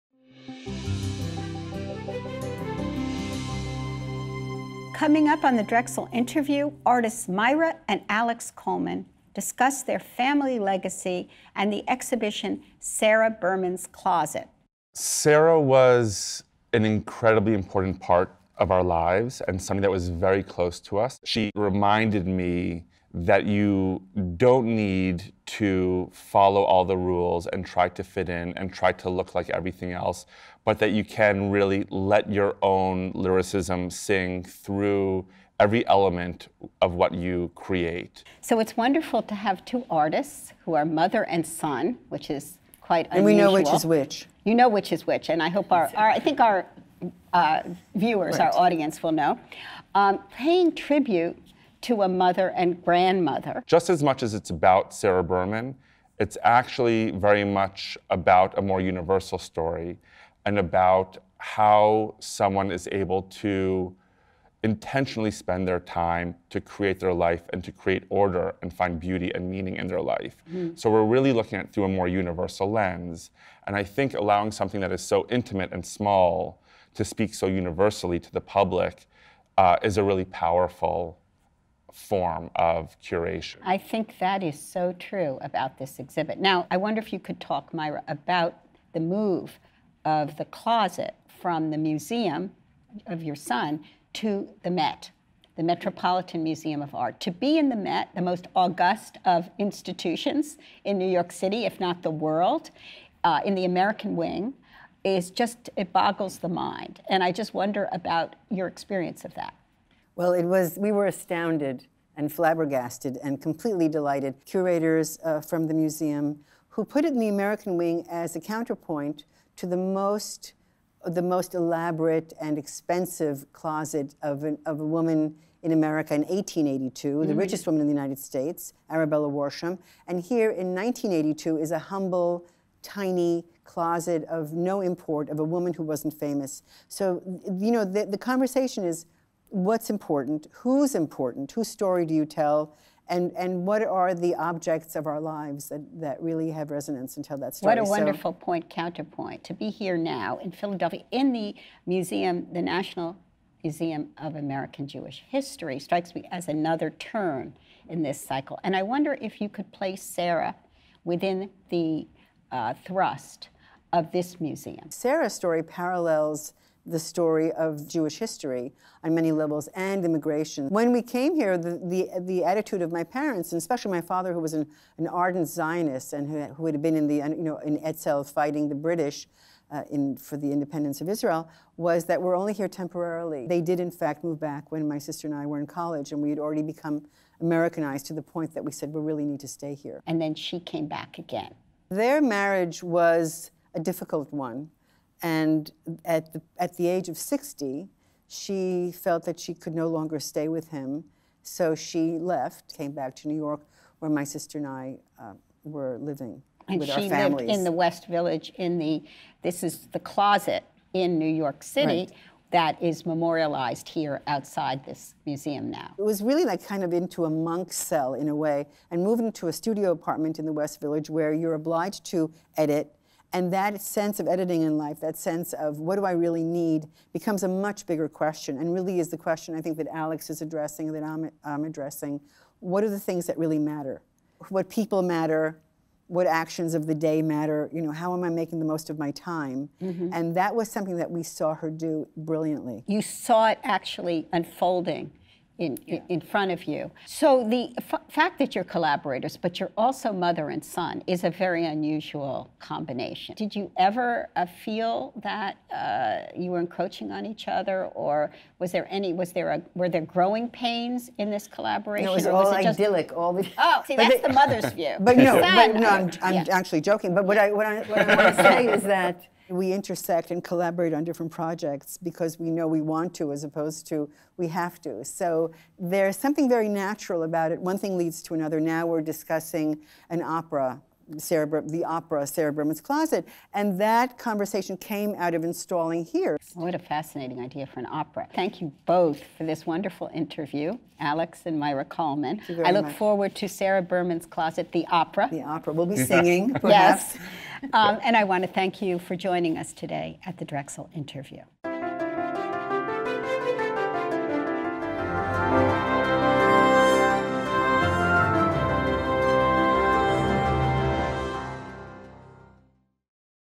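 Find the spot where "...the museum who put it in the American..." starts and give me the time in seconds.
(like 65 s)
115 s.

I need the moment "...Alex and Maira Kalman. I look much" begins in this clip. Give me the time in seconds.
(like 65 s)
290 s.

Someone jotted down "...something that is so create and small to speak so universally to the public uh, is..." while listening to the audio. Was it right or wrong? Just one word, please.
wrong.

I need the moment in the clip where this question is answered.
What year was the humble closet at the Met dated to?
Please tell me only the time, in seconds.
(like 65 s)
130 s.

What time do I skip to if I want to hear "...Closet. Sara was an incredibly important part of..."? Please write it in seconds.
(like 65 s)
13 s.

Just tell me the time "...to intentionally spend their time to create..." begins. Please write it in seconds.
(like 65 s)
63 s.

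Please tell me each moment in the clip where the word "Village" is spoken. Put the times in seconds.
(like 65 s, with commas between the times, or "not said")
208 s, 220 s.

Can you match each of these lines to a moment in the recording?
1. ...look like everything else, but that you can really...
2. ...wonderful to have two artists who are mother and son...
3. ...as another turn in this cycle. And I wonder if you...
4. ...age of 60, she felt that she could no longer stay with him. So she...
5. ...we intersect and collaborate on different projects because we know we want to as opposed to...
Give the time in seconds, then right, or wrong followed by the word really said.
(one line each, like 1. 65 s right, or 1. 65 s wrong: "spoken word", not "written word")
1. 29 s right
2. 38 s right
3. 156 s right
4. 196 s right
5. 269 s right.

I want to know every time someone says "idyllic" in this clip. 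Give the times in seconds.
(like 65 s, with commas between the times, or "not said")
262 s.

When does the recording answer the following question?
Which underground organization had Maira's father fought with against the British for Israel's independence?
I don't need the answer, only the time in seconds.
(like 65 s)
177 s.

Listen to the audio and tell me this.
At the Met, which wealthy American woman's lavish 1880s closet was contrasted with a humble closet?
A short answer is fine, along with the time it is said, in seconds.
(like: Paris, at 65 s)
Arabella Worsham, at 128 s.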